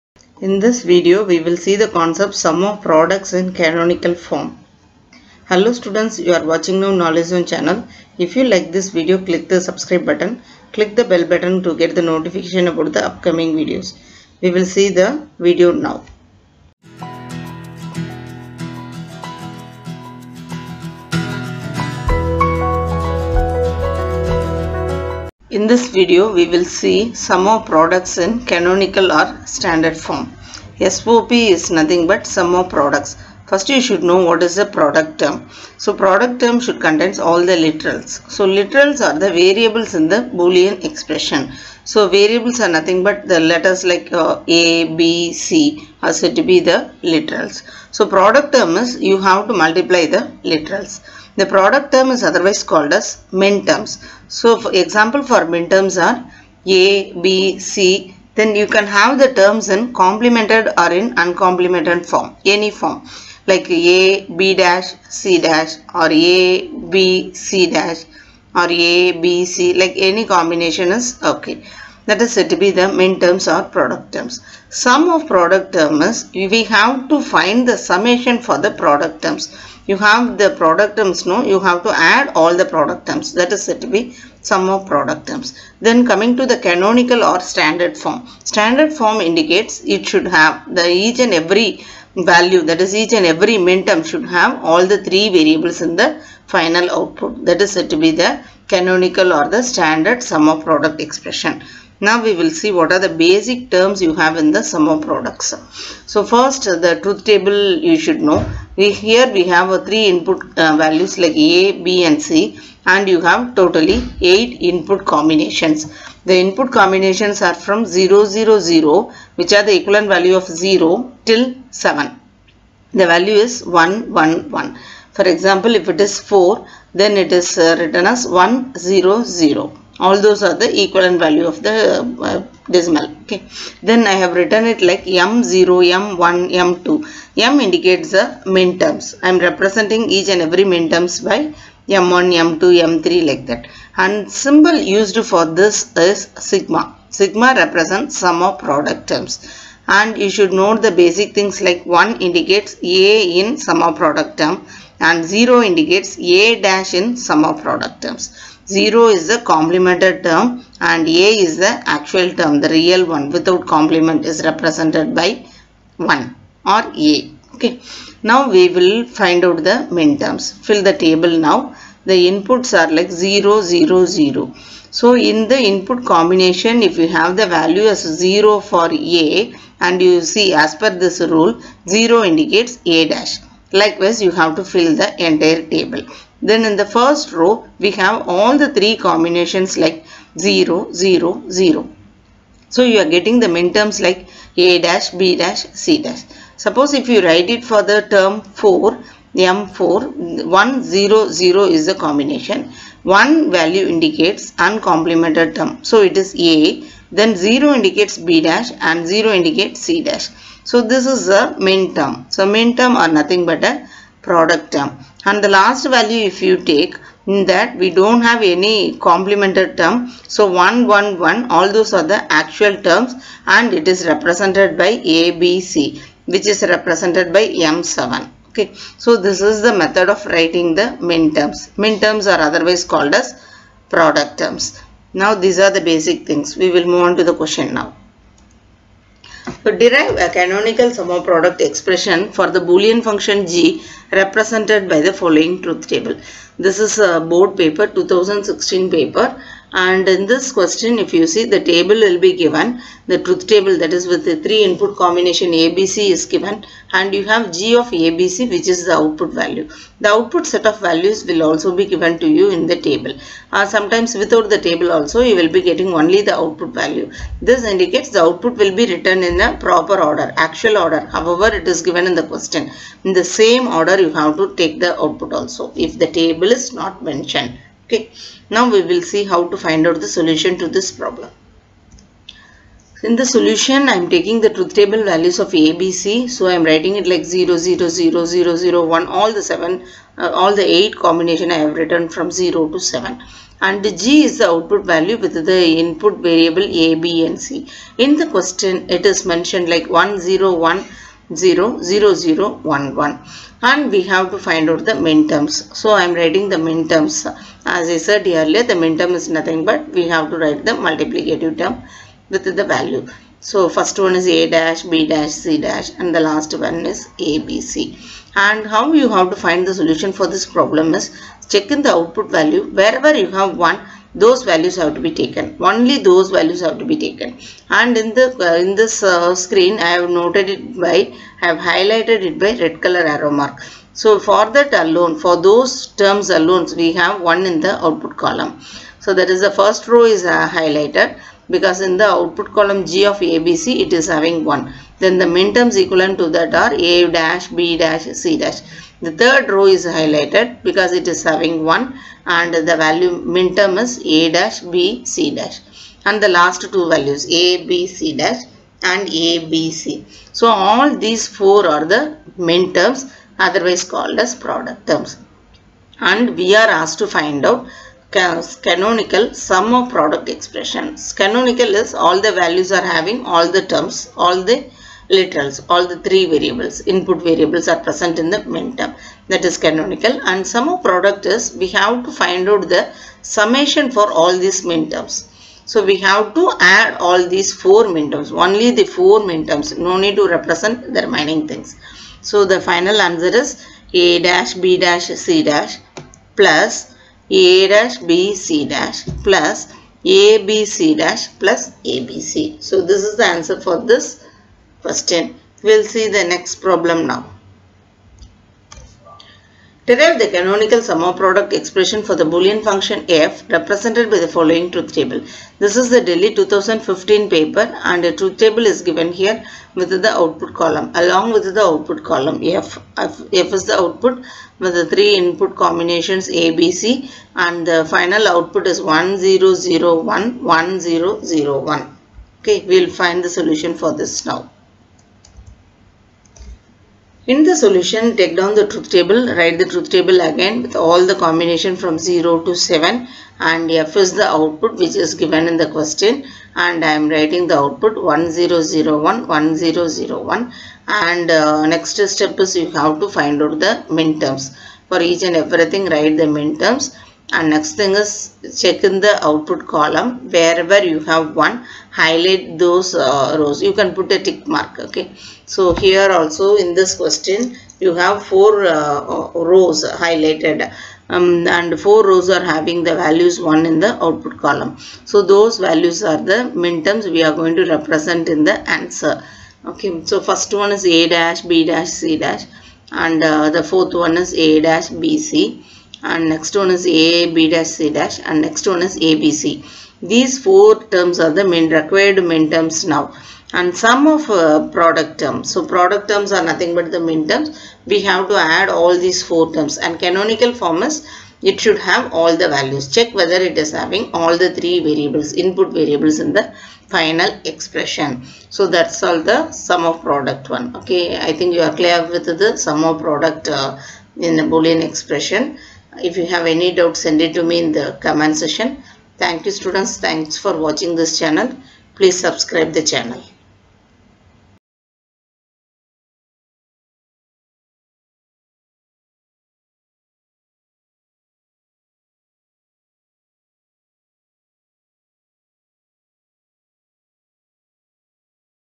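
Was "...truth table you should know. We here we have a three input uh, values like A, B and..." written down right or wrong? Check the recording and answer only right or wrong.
right.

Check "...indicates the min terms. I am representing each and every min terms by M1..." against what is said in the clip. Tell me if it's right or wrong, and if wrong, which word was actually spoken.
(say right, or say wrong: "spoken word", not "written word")
right.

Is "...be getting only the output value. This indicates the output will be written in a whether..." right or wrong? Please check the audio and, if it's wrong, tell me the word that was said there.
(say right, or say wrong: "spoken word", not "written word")
wrong: "proper", not "whether".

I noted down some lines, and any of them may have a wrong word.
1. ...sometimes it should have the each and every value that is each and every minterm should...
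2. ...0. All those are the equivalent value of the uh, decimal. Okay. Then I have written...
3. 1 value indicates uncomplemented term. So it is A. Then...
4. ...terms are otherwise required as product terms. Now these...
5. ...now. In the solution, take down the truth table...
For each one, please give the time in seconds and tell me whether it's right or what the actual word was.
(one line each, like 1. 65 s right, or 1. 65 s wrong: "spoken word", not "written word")
1. 89 s wrong: "indicates", not "sometimes"
2. 129 s right
3. 203 s right
4. 232 s wrong: "called", not "required"
5. 434 s right.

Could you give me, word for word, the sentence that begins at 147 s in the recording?
Sigma represents sum of product terms.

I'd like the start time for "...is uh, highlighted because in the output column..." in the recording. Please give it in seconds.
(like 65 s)
340 s.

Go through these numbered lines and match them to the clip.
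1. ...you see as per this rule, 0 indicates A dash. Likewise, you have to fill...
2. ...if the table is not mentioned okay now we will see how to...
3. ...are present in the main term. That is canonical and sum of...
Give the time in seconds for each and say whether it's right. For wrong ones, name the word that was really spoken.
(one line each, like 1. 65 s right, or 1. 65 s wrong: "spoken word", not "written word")
1. 180 s right
2. 275 s right
3. 377 s right.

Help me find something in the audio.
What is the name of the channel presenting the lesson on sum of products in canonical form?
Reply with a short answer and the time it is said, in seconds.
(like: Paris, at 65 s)
Knowledge Zone, at 6 s.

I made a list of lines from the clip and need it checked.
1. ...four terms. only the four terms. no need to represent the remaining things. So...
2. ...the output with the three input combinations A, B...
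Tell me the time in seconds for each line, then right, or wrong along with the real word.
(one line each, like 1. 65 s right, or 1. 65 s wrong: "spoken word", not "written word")
1. 387 s right
2. 423 s right.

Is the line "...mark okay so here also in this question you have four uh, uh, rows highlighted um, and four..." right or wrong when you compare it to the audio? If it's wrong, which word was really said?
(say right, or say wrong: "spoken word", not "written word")
right.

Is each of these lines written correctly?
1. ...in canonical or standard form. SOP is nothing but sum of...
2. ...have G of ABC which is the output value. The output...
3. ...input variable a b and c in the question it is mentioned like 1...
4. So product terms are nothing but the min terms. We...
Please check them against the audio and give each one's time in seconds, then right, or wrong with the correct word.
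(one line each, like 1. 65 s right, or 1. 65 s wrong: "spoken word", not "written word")
1. 28 s right
2. 257 s right
3. 295 s right
4. 495 s right.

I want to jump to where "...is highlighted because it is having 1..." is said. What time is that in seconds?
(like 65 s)
349 s.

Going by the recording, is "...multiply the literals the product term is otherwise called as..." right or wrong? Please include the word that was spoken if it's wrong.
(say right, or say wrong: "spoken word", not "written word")
right.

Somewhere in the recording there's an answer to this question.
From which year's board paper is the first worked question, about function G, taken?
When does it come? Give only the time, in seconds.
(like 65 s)
247 s.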